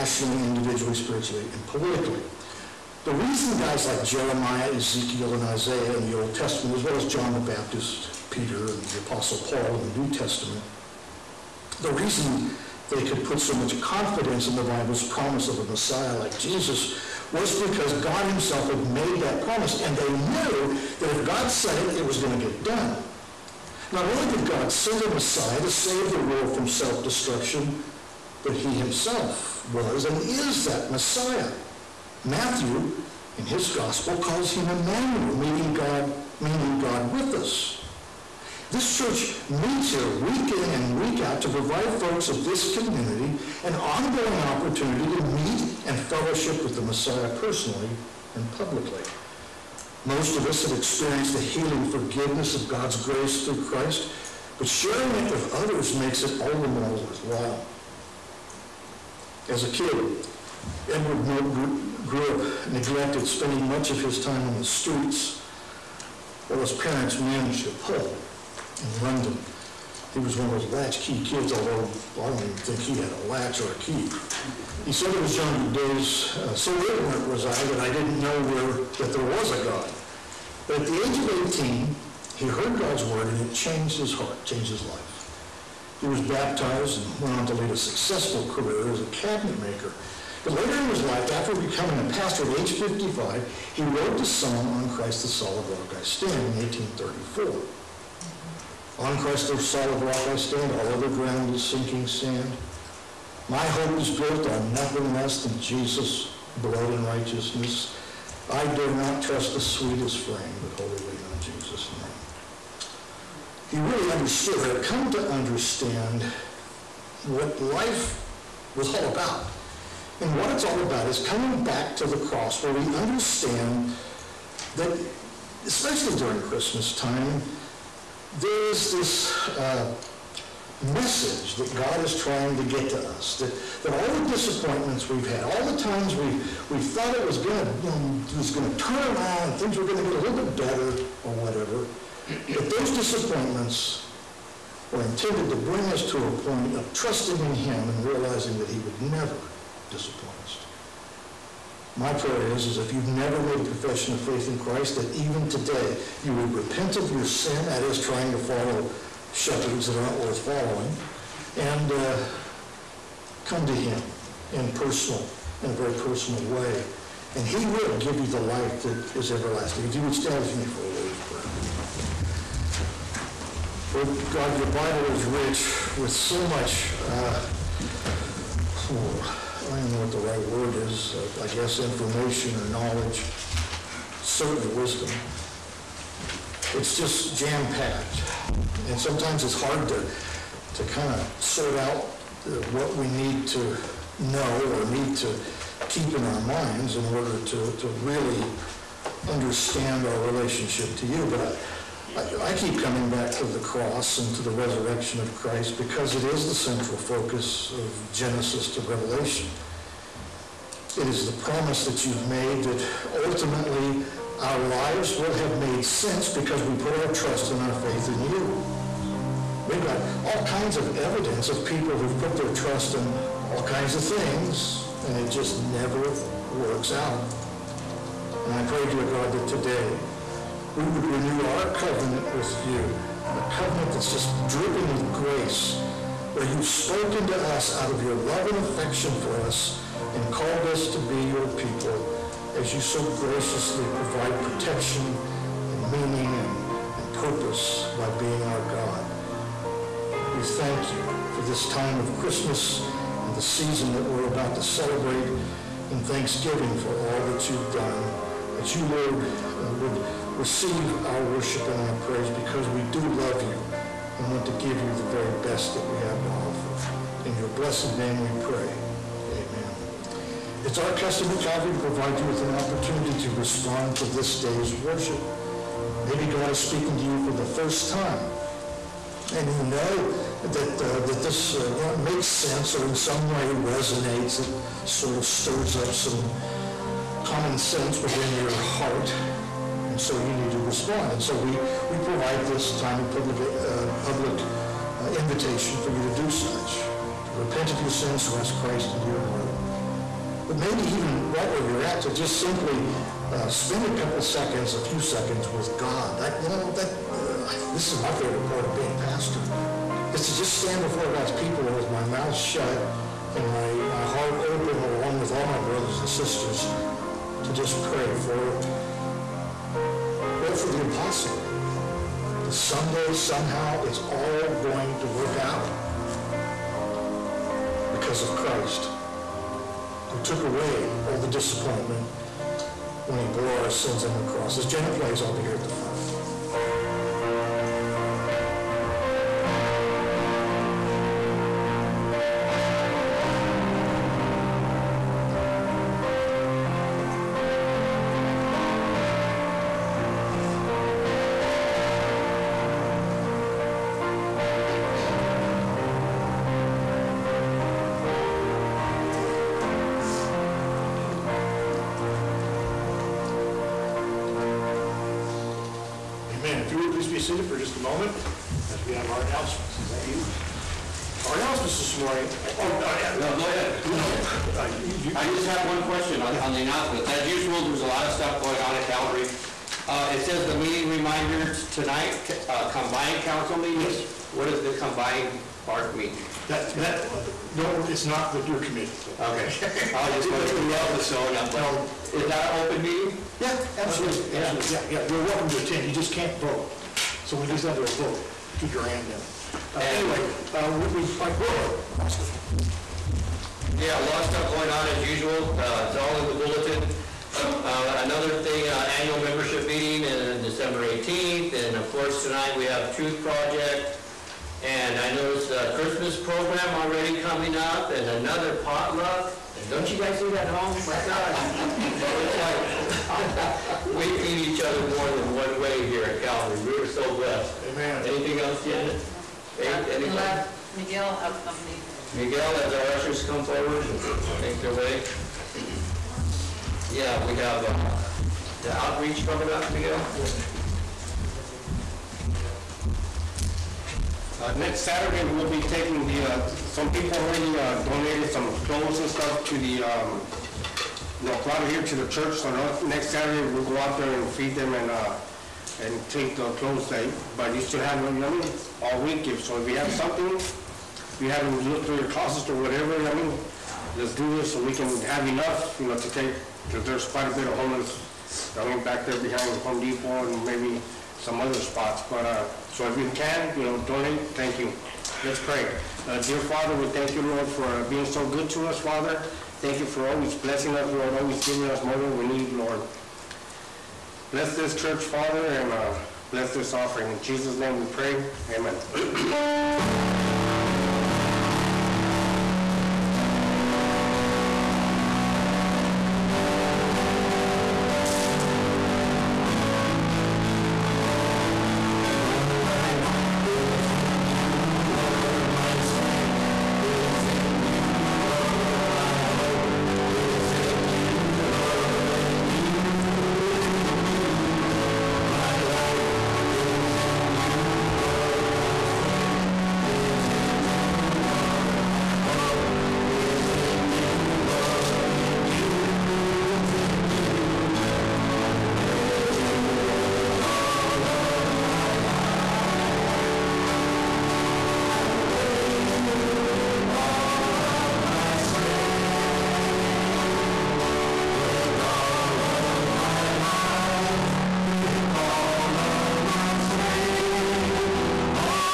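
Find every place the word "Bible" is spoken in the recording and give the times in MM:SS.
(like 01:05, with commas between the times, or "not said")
00:14, 02:54.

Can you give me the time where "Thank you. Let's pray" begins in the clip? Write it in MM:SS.
07:54.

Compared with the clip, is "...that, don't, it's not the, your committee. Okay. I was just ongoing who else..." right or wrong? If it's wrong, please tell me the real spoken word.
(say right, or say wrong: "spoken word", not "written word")
wrong: "wondering", not "ongoing".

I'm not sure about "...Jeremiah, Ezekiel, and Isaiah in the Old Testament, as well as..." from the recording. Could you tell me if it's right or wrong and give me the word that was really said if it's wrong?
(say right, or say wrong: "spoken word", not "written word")
right.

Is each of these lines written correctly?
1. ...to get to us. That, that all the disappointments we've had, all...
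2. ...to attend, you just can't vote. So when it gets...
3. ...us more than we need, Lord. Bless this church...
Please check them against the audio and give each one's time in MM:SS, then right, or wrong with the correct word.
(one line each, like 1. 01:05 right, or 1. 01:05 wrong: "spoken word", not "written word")
1. 02:12 right
2. 06:35 right
3. 08:01 right.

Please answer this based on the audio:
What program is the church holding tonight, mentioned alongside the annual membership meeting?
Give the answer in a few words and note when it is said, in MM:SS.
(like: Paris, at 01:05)
Truth Project, at 06:52.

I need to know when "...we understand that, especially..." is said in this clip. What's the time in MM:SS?
02:02.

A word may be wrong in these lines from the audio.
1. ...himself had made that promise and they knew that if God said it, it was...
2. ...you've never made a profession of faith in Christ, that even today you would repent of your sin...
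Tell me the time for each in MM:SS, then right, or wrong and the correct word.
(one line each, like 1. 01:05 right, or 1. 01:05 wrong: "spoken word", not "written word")
1. 00:18 right
2. 02:32 right.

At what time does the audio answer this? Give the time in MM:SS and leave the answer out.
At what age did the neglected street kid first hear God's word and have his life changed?
01:21.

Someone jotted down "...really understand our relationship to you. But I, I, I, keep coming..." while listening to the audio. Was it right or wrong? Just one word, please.
right.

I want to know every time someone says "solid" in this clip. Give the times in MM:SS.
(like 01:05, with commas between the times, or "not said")
01:35, 01:39.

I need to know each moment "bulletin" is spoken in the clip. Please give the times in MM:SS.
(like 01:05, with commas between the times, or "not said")
06:46.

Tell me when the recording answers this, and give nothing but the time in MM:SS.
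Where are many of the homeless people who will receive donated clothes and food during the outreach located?
07:49.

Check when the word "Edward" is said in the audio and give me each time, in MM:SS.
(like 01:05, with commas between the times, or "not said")
01:00.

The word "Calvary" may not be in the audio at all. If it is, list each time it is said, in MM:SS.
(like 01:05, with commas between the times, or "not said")
04:31, 07:06.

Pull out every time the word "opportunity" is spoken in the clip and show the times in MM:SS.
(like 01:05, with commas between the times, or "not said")
00:44, 04:32.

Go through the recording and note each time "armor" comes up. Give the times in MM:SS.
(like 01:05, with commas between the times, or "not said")
not said.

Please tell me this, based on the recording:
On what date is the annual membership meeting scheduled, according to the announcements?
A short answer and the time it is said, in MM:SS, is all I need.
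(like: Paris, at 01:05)
December 18th, at 06:50.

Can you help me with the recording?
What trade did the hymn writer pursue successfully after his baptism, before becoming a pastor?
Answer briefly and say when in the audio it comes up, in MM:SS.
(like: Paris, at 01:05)
cabinet maker, at 01:29.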